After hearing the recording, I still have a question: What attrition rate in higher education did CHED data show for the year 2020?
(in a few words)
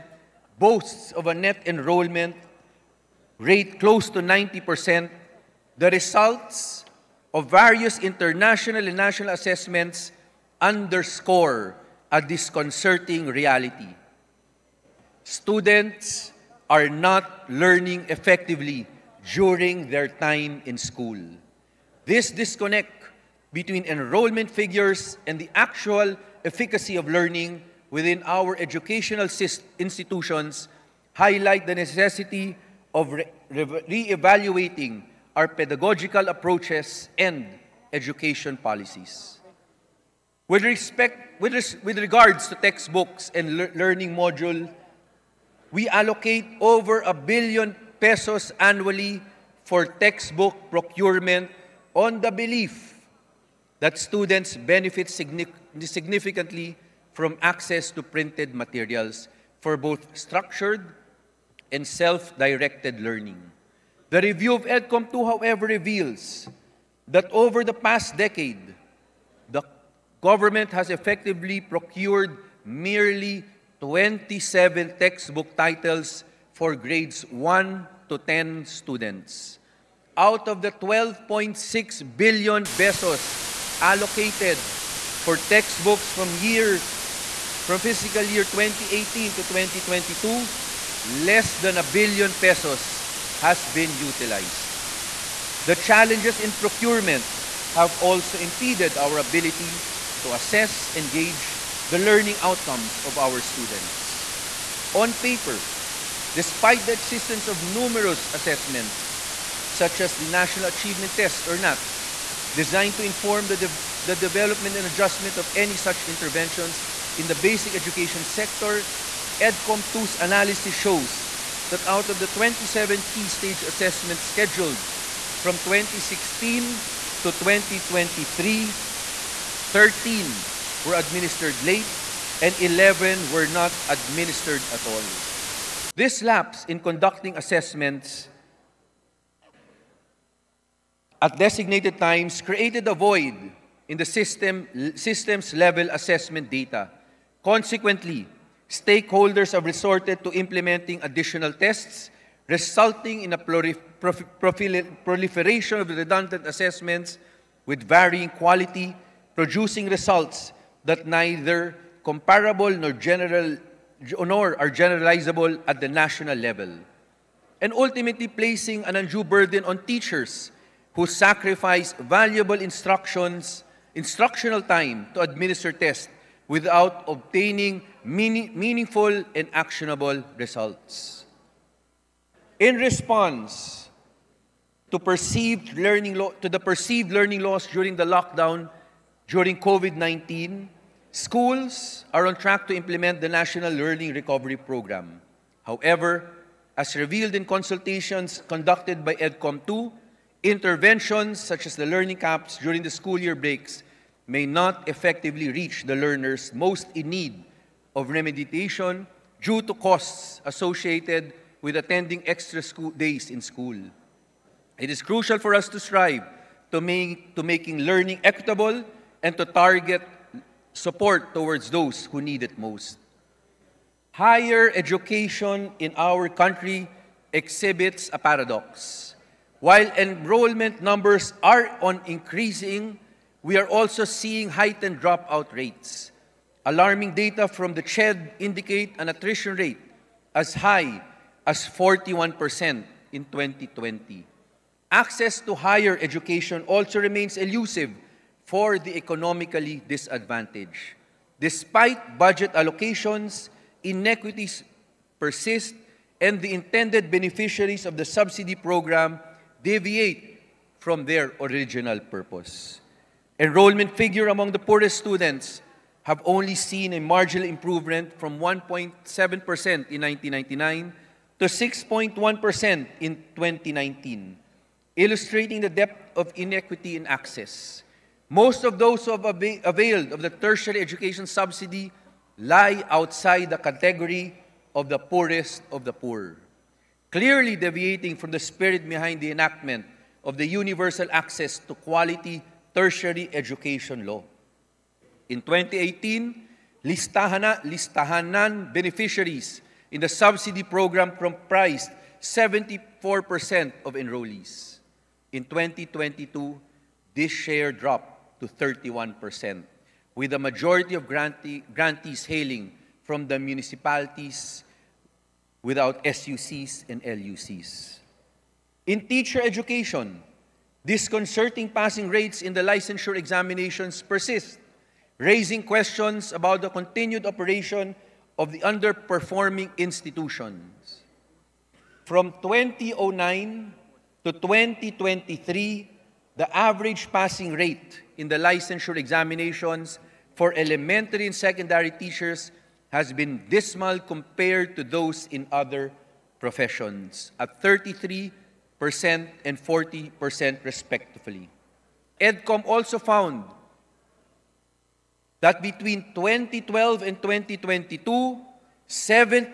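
41%.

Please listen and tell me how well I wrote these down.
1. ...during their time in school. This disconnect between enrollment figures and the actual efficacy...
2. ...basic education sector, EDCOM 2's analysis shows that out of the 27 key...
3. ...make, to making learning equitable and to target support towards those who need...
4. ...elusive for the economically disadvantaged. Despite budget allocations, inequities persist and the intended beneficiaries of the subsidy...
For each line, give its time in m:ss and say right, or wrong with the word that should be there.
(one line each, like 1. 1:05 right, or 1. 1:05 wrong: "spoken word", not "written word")
1. 0:19 right
2. 1:57 right
3. 3:36 right
4. 4:07 right.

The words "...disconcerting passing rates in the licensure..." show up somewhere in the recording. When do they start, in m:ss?
5:20.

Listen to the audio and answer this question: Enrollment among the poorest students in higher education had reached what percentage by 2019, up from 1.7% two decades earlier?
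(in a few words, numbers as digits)
6.1%.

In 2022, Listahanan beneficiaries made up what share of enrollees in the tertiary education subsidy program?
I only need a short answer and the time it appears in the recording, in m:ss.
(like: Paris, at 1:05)
31%, at 5:08.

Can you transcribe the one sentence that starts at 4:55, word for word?
In 2018, listahana, listahanan beneficiaries in the subsidy program comprised 74% of enrollees.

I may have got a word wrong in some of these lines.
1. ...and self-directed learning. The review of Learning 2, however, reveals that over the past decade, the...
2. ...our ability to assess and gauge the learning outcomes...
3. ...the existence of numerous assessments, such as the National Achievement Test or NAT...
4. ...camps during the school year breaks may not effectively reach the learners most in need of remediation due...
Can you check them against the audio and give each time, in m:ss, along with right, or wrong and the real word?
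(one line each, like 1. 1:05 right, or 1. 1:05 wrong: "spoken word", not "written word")
1. 1:01 wrong: "EDCOM", not "Learning"
2. 1:39 right
3. 1:46 right
4. 3:22 right.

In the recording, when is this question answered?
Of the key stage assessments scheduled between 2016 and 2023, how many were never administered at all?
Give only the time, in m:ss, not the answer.
2:12.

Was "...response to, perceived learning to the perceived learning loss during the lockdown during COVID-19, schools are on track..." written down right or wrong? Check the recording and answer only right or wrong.
right.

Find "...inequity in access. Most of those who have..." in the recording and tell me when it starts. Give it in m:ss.
4:36.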